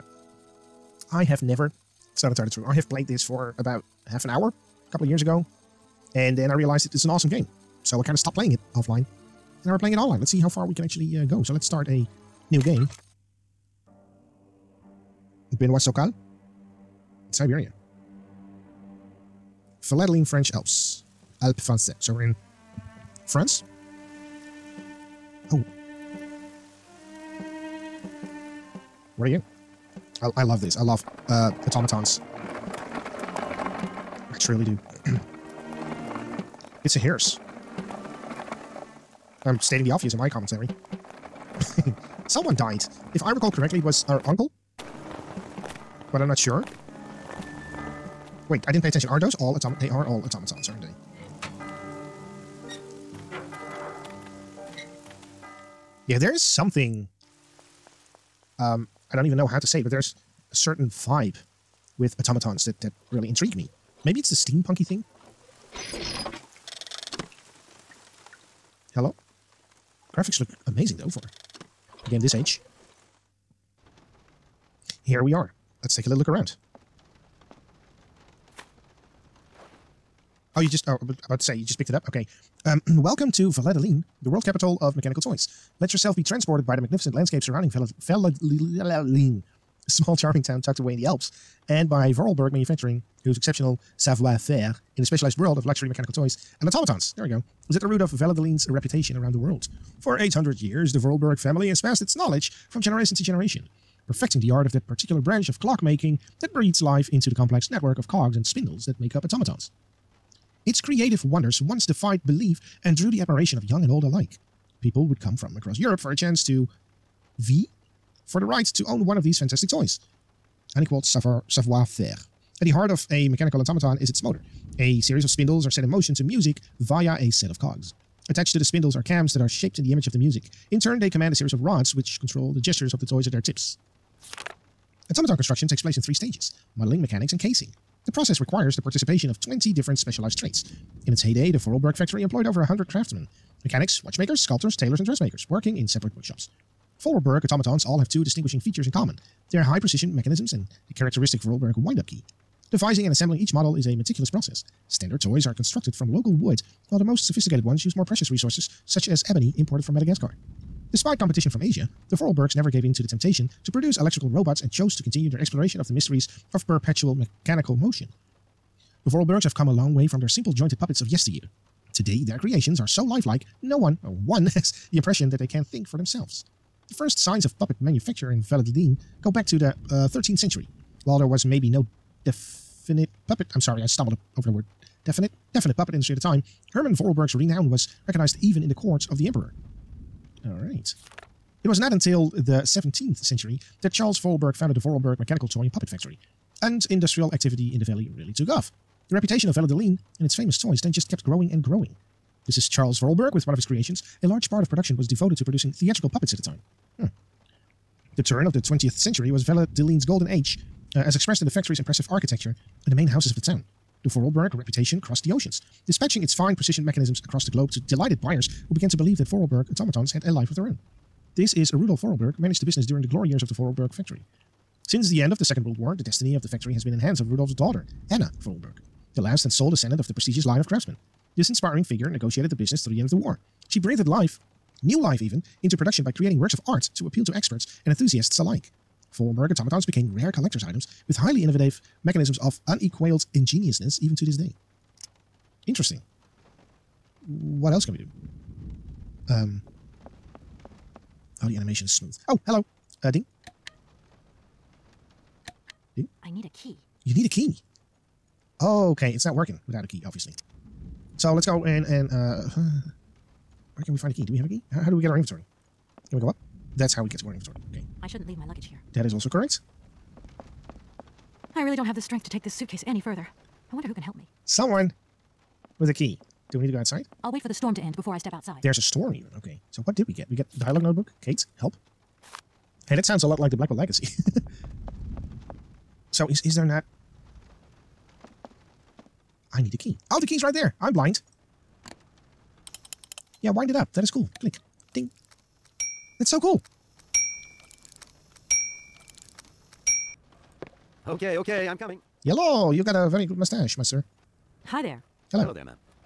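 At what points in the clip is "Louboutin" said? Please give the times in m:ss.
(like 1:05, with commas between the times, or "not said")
not said.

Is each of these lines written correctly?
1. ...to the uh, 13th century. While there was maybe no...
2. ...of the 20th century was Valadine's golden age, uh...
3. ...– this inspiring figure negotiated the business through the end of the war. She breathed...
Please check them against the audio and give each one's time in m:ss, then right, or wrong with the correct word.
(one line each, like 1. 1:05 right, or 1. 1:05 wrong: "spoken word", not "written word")
1. 2:59 right
2. 3:28 right
3. 3:50 right.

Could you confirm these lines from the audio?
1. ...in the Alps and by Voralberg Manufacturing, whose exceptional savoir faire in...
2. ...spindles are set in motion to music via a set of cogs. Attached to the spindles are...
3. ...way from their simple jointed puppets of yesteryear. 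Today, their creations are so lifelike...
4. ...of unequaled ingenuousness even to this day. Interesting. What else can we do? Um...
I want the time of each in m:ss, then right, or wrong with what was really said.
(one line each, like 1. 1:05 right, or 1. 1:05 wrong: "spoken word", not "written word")
1. 1:30 right
2. 2:05 right
3. 2:49 right
4. 4:02 right.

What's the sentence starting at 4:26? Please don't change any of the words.
That's how we get to our inventory.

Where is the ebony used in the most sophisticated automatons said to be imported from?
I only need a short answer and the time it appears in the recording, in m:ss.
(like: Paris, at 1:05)
Madagascar, at 2:39.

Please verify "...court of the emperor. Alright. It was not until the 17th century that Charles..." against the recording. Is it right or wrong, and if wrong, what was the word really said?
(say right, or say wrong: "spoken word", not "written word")
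right.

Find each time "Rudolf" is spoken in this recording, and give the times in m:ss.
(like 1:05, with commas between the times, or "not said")
3:41, 3:47.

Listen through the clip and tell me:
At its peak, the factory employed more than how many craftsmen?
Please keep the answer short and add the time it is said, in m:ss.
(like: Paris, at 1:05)
100, at 2:22.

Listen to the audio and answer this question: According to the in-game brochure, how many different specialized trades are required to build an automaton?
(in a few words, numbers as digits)
20.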